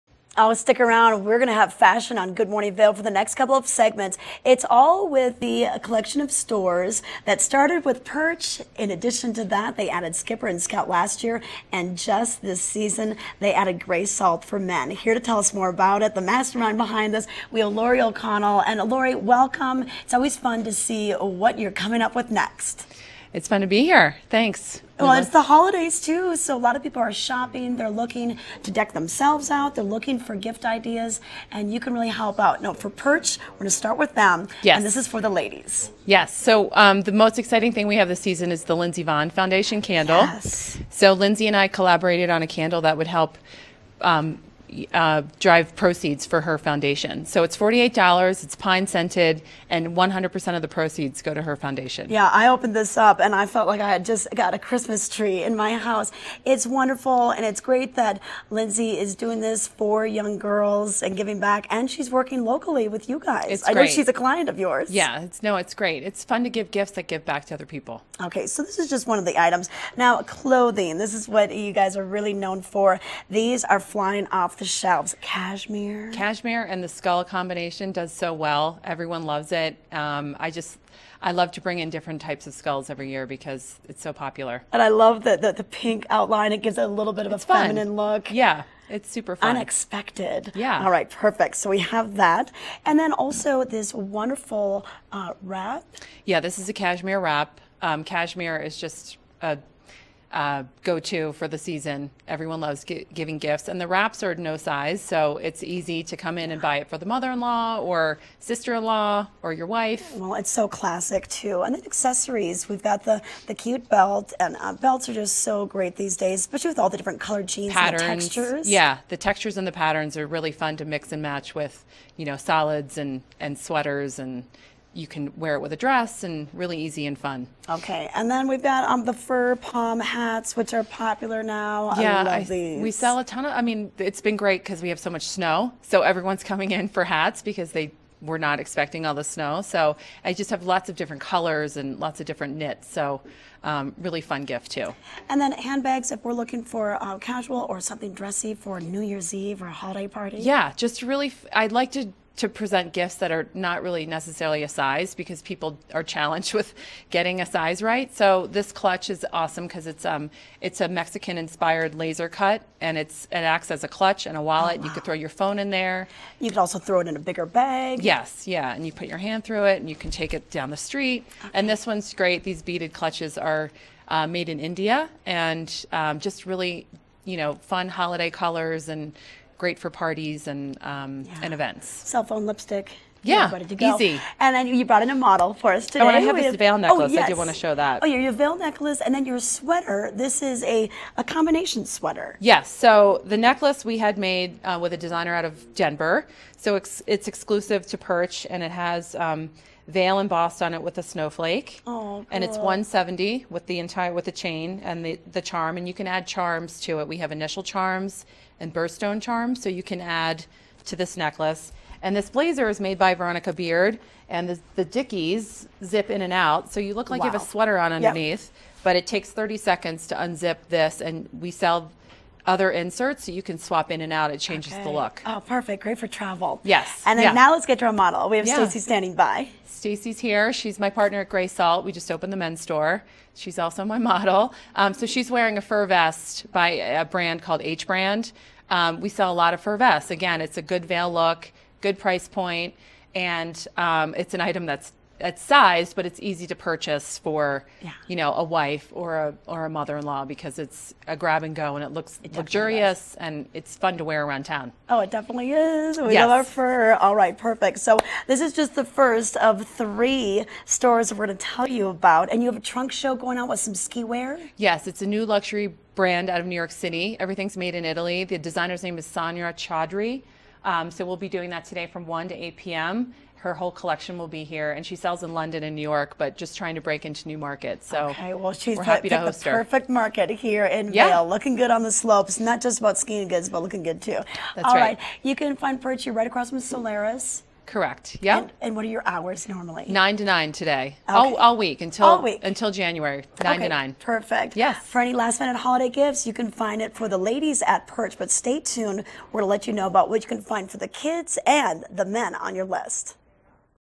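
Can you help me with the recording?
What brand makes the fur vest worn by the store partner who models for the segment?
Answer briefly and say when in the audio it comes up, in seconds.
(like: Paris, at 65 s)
H Brand, at 237 s.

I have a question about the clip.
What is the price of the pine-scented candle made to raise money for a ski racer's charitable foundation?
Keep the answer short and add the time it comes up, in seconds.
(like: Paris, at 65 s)
$48, at 47 s.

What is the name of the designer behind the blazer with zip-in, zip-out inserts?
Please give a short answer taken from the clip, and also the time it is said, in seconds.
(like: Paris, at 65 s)
Veronica Beard, at 213 s.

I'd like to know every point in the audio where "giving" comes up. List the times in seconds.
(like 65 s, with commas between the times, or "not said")
61 s, 102 s.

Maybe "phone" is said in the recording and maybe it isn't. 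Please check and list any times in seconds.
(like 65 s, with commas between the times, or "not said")
165 s, 182 s.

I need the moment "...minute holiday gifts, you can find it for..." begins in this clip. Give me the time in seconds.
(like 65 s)
295 s.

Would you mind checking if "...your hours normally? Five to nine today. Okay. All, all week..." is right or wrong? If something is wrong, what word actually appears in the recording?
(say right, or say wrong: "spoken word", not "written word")
wrong: "Nine", not "Five".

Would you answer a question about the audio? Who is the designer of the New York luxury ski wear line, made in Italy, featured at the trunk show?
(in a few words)
Sonia Chaudhry.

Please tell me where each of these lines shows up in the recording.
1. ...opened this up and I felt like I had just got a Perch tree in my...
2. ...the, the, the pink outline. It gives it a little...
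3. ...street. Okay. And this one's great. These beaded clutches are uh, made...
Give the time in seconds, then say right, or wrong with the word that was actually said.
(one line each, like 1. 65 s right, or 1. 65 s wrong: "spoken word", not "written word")
1. 52 s wrong: "Christmas", not "Perch"
2. 85 s right
3. 170 s right.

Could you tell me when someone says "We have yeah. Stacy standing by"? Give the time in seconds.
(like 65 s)
228 s.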